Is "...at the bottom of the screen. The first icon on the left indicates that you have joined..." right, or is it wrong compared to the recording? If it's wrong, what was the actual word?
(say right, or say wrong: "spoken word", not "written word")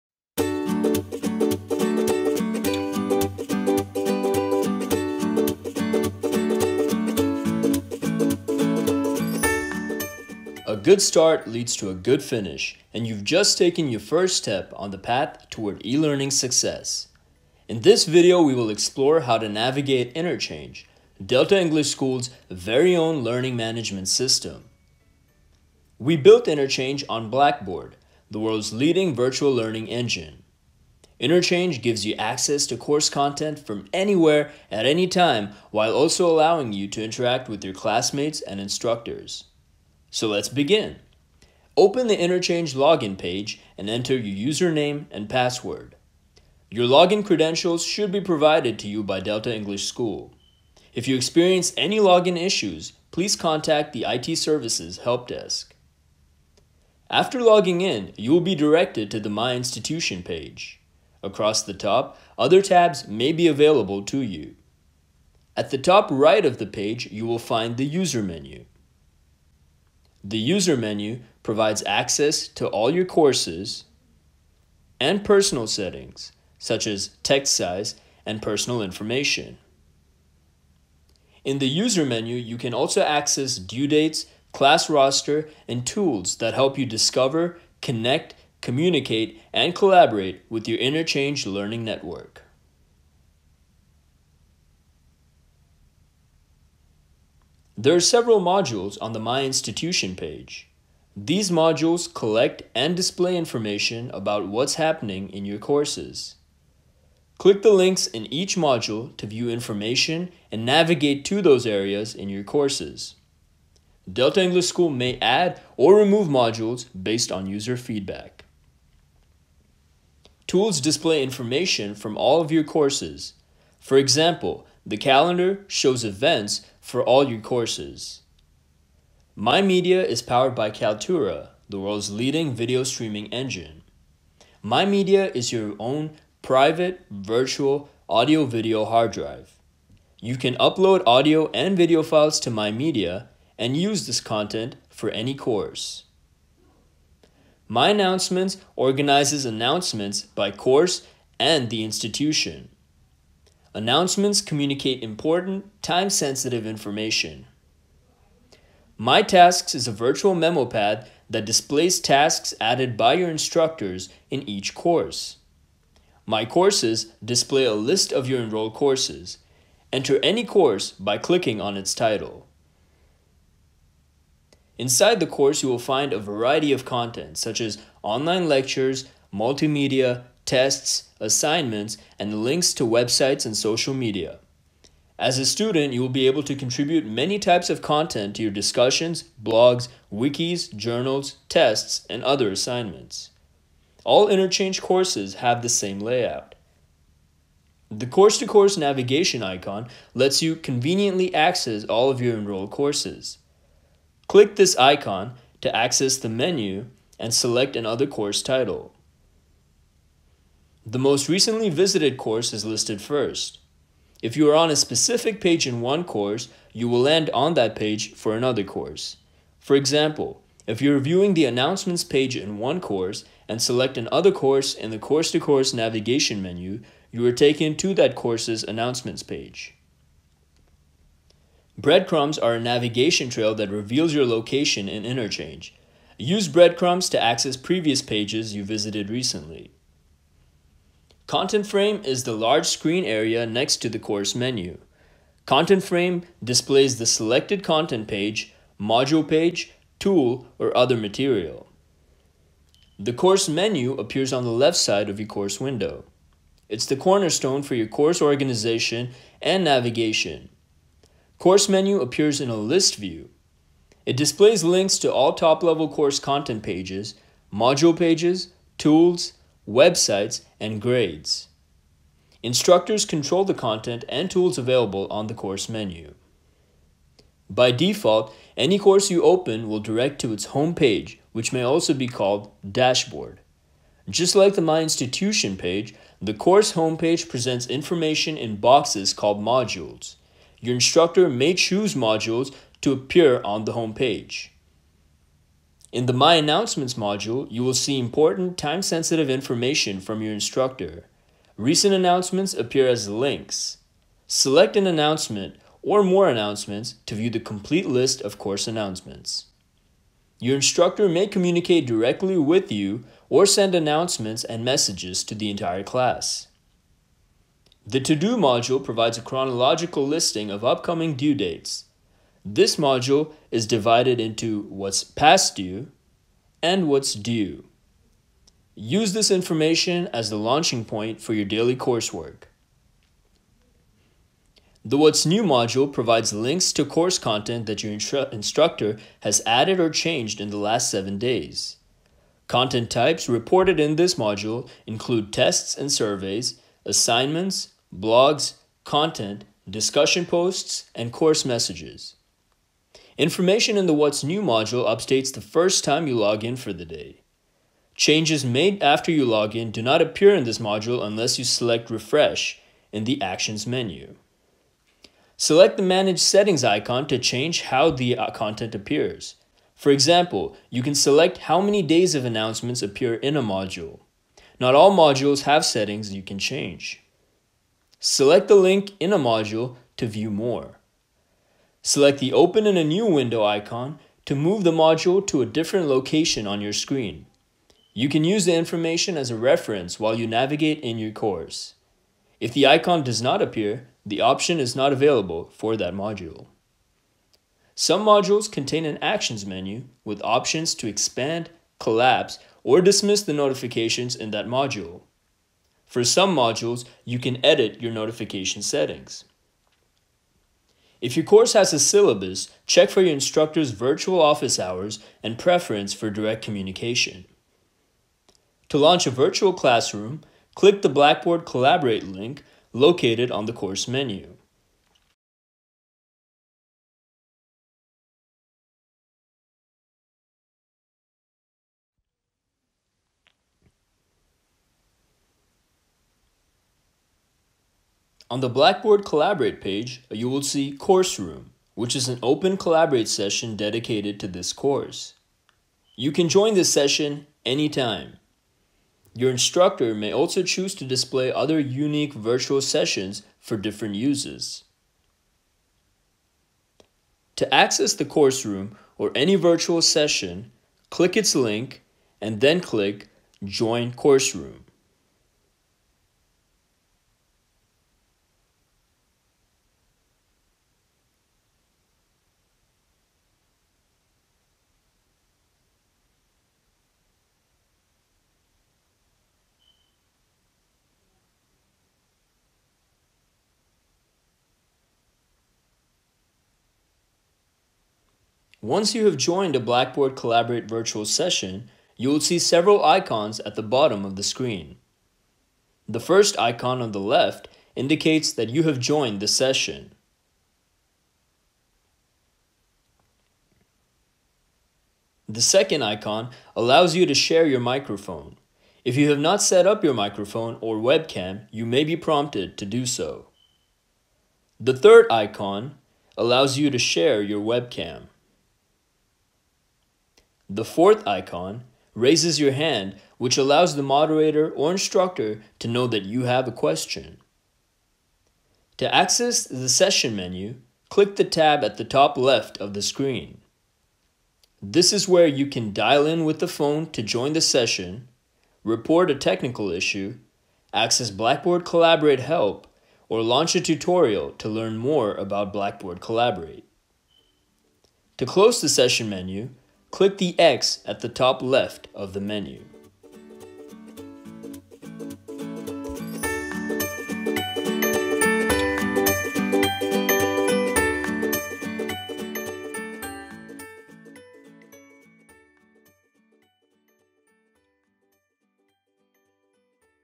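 right.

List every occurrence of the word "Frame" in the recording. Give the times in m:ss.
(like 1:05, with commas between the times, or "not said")
4:01, 4:05.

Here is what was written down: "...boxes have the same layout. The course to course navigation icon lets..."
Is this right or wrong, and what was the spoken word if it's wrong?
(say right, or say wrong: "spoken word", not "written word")
wrong: "courses", not "boxes".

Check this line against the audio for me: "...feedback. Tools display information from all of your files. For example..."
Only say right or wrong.
wrong.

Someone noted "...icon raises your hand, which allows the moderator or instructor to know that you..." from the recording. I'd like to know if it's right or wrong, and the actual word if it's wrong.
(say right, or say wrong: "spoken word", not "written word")
right.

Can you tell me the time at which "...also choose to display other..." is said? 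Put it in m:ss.
7:30.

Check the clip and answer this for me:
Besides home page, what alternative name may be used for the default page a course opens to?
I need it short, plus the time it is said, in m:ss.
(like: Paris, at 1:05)
dashboard, at 4:42.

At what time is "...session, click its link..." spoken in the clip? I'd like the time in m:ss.
7:39.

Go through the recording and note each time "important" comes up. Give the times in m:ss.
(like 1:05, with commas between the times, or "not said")
2:35, 4:57.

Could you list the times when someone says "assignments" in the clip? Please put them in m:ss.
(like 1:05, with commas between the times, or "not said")
3:01, 3:12, 5:46.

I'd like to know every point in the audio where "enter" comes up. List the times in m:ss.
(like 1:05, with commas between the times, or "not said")
0:43, 2:49.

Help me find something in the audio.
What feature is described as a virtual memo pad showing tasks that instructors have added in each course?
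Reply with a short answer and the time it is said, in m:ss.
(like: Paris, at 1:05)
My Tasks, at 2:38.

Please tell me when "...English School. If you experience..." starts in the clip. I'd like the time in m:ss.
0:49.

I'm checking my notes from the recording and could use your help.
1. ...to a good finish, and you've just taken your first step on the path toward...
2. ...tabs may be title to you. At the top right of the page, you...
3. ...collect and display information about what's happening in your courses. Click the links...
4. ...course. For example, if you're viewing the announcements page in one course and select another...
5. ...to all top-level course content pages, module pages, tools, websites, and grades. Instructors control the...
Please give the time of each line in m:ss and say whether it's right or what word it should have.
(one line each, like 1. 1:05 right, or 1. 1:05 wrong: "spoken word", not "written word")
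1. 0:11 right
2. 1:02 wrong: "available", not "title"
3. 1:42 right
4. 3:38 right
5. 4:24 right.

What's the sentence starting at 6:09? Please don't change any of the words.
For example, you can select how many days of announcements appear in a module.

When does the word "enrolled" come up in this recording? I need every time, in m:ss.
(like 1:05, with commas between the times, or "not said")
2:48, 3:22.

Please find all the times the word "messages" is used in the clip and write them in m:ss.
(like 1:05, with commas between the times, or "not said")
5:14, 5:51.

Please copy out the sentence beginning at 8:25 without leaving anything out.
The second icon allows you to share your microphone.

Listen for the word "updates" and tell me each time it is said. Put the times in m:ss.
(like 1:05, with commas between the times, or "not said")
5:54.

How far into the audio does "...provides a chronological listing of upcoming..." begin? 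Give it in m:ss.
5:18.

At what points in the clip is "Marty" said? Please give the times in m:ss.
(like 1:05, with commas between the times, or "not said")
not said.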